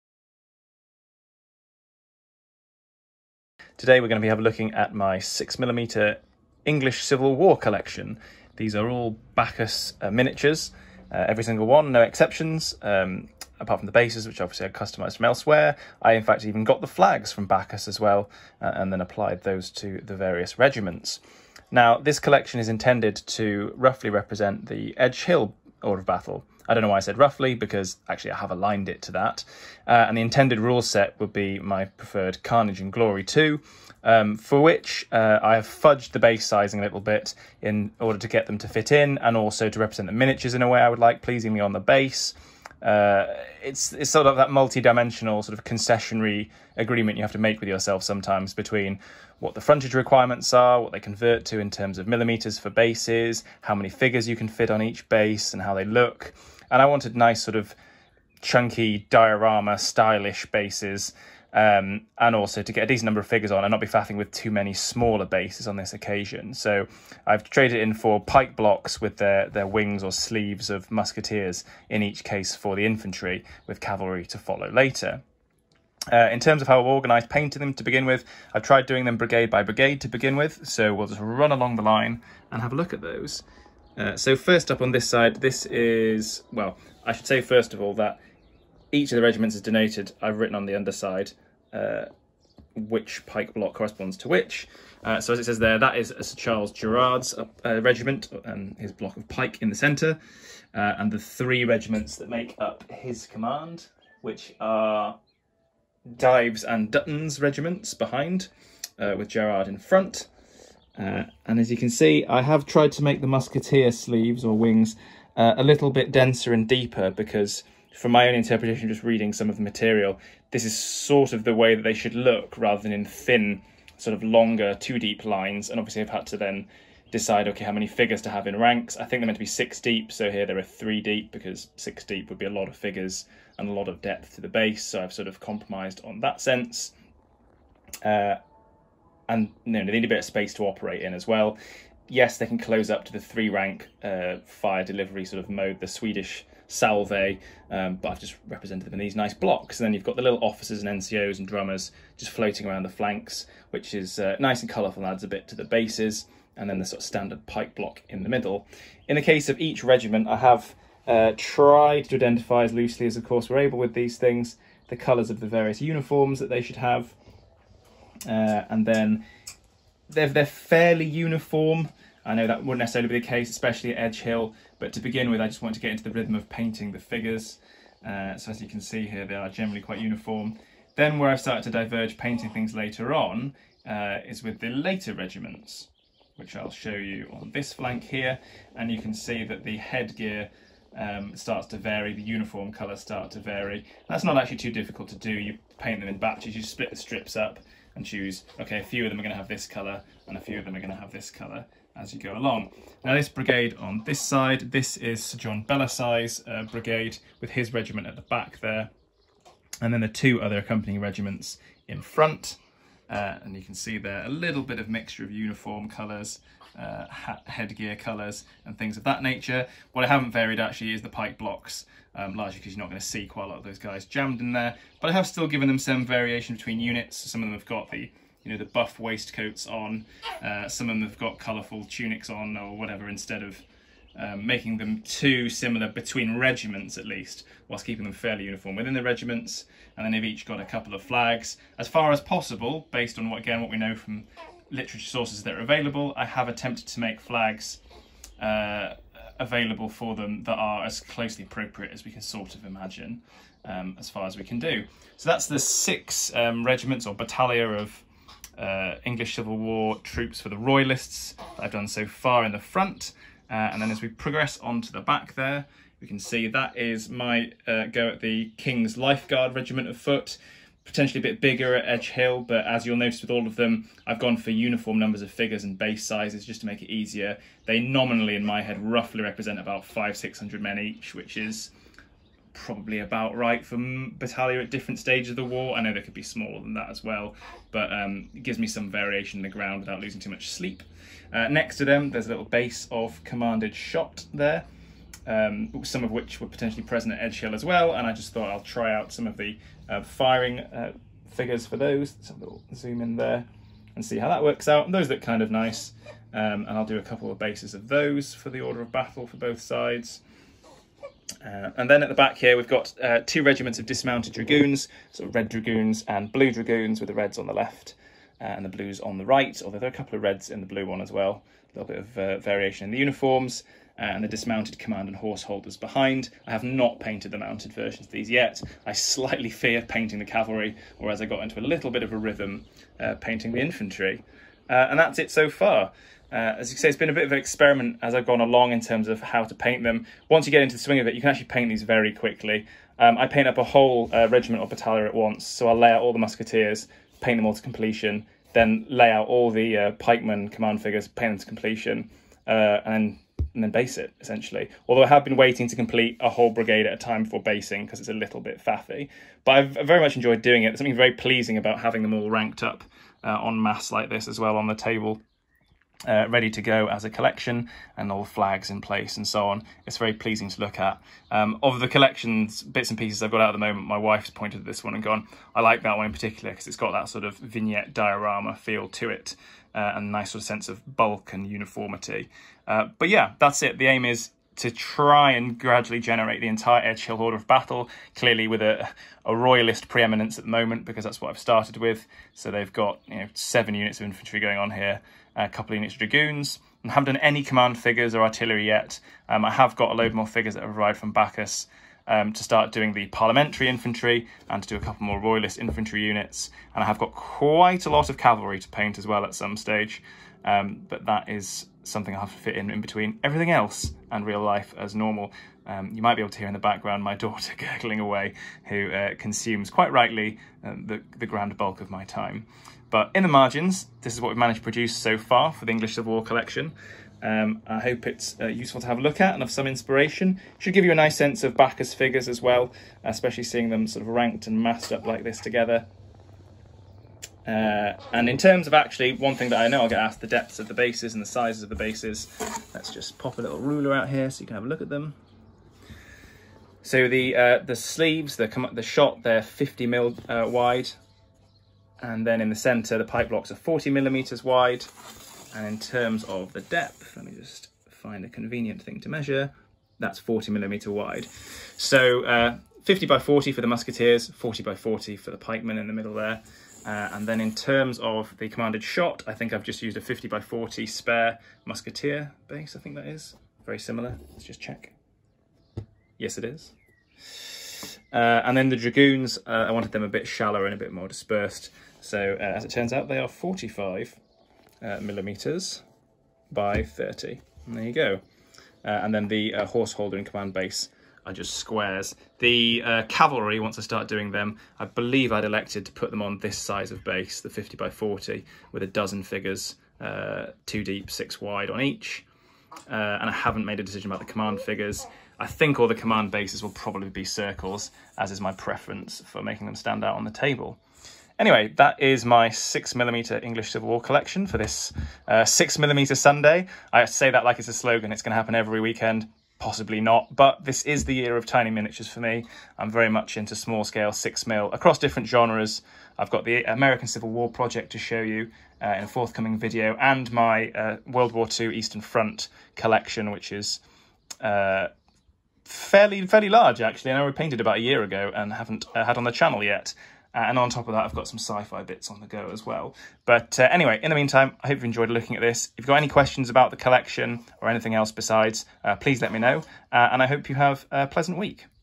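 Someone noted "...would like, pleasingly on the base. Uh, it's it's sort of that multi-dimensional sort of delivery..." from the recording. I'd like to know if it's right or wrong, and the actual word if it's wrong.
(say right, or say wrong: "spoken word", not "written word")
wrong: "concessionary", not "delivery".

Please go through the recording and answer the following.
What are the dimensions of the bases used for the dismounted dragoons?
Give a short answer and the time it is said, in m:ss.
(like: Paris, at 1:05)
45 by 30 mm, at 8:03.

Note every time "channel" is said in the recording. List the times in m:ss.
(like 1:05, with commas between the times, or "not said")
8:59.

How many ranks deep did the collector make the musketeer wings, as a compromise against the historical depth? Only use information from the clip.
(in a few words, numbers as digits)
3.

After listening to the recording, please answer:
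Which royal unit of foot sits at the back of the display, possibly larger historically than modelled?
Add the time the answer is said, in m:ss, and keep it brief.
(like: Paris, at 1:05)
King's Lifeguard Regiment of Foot, at 4:28.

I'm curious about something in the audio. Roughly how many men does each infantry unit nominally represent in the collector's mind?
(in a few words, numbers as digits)
500-600.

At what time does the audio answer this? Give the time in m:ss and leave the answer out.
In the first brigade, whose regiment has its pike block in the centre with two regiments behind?
1:36.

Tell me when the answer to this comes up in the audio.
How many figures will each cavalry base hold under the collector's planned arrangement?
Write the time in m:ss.
8:18.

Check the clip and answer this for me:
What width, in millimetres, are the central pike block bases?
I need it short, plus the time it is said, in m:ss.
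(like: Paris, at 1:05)
40, at 7:33.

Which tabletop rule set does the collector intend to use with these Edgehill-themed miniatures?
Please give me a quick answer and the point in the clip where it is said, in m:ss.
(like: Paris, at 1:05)
Carnage and Glory 2, at 0:32.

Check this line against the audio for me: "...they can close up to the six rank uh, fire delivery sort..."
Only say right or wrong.
wrong.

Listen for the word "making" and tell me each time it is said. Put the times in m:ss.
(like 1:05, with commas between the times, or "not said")
3:54, 8:29.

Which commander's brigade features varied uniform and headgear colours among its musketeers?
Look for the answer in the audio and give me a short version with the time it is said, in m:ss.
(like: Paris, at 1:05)
Sir John Belasyse, at 3:25.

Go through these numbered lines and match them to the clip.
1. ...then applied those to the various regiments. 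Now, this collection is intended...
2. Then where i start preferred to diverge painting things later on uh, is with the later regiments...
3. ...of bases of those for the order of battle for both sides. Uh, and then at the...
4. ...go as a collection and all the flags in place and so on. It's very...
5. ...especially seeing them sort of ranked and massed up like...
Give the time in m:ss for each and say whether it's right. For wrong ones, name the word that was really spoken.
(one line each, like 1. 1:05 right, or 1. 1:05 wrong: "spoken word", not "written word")
1. 0:18 right
2. 3:00 wrong: "started", not "preferred"
3. 5:07 right
4. 6:06 right
5. 7:13 right.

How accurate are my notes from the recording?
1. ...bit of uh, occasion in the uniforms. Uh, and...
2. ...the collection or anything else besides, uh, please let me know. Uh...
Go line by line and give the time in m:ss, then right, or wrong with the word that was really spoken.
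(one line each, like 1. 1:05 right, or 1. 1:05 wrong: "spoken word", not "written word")
1. 5:21 wrong: "variation", not "occasion"
2. 9:06 right.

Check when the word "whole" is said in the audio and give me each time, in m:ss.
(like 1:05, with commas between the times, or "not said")
5:43, 5:56.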